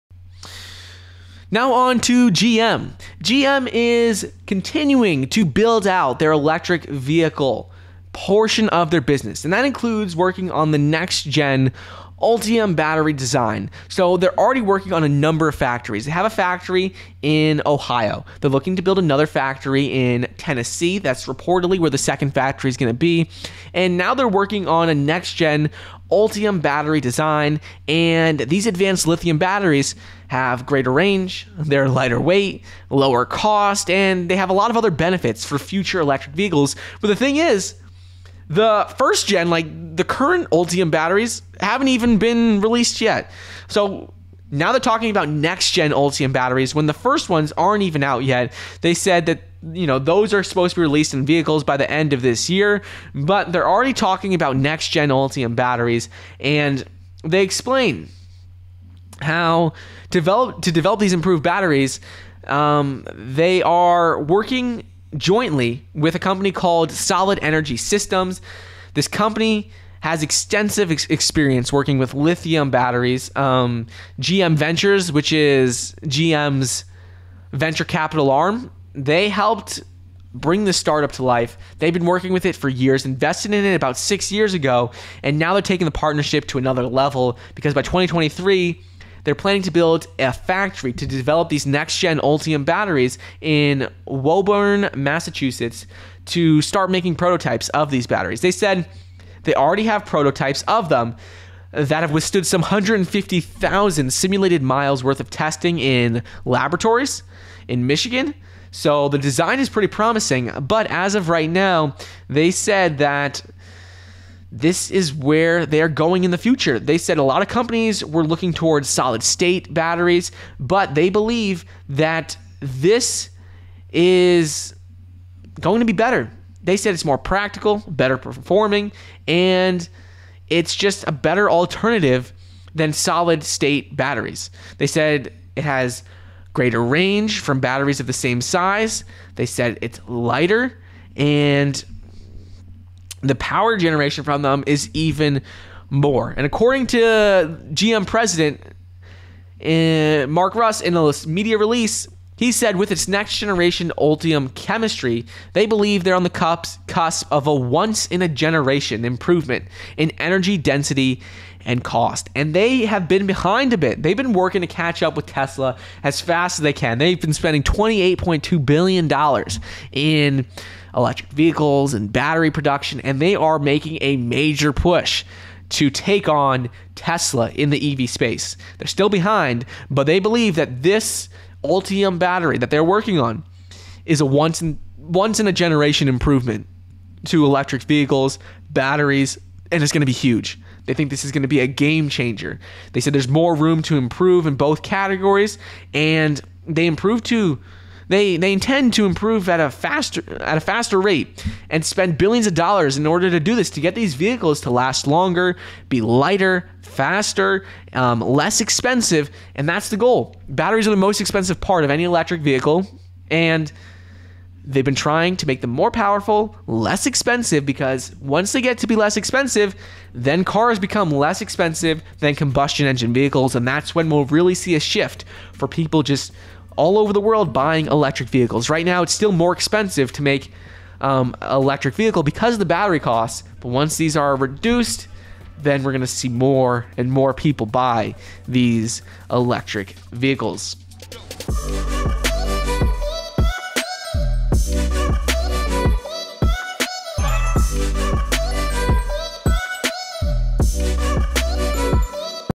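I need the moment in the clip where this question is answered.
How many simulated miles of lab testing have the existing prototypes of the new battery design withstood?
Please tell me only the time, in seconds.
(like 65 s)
102 s.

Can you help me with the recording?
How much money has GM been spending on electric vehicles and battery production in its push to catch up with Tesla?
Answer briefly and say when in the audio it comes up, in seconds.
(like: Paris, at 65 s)
$28.2 billion, at 167 s.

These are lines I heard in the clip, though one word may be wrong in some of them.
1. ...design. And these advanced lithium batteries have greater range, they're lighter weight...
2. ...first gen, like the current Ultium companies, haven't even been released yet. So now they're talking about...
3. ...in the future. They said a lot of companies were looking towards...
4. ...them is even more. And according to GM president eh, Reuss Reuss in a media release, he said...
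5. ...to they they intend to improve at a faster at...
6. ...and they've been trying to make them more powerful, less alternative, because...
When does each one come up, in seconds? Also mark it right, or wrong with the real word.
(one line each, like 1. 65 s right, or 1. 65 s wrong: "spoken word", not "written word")
1. 27 s right
2. 38 s wrong: "batteries", not "companies"
3. 116 s right
4. 144 s wrong: "Mark", not "Reuss"
5. 197 s right
6. 213 s wrong: "expensive", not "alternative".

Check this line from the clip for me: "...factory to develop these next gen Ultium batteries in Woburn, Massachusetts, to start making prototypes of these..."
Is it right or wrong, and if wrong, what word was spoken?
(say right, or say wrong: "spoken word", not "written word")
right.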